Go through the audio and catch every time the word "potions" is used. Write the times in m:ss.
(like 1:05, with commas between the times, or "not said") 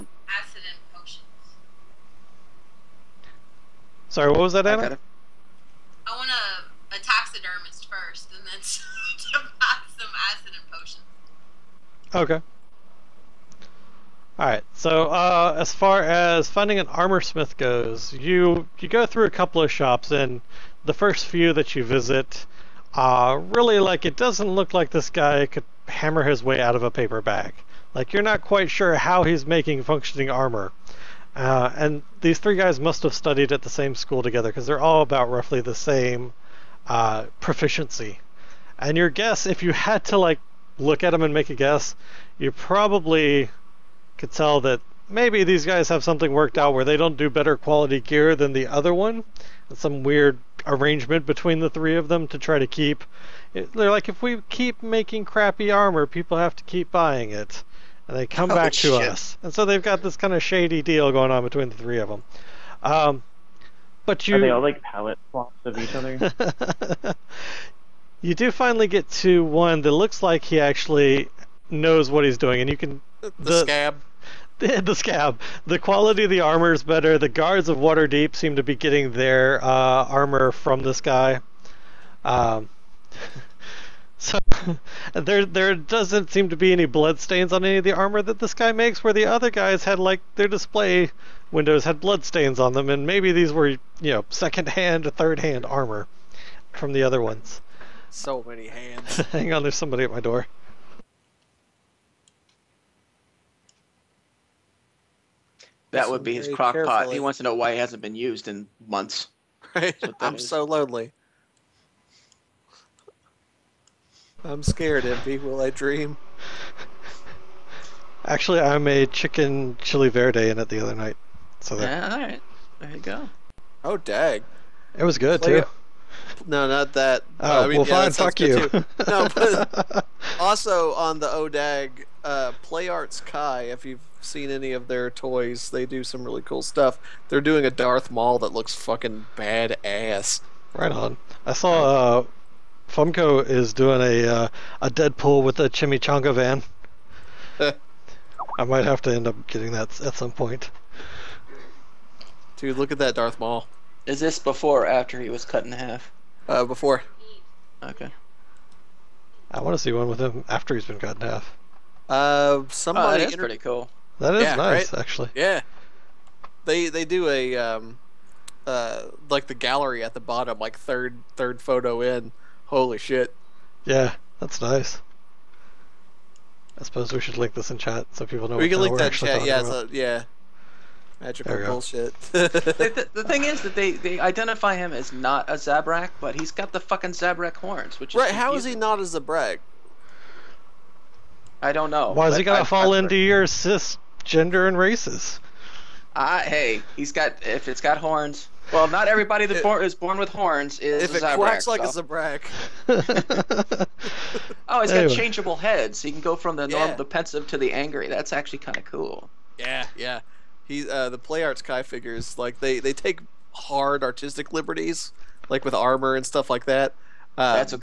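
0:00, 0:10.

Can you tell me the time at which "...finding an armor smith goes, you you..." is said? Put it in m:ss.
0:16.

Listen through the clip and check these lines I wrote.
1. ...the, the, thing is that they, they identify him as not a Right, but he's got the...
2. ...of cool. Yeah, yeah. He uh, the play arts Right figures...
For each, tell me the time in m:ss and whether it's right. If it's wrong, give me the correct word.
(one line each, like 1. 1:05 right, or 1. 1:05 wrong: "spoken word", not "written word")
1. 3:03 wrong: "Zabrak", not "Right"
2. 3:28 wrong: "Kai", not "Right".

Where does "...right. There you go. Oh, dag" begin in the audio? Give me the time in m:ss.
2:02.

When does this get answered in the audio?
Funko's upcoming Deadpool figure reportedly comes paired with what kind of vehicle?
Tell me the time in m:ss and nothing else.
2:25.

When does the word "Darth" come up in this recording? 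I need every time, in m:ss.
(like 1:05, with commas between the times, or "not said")
2:17, 2:33.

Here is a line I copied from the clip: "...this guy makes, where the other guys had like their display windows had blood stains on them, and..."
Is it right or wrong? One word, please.
right.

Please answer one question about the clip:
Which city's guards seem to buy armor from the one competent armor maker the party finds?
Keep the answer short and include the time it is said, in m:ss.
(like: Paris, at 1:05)
Waterdeep, at 1:17.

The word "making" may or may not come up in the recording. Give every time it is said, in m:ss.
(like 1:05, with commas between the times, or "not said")
0:29, 0:54.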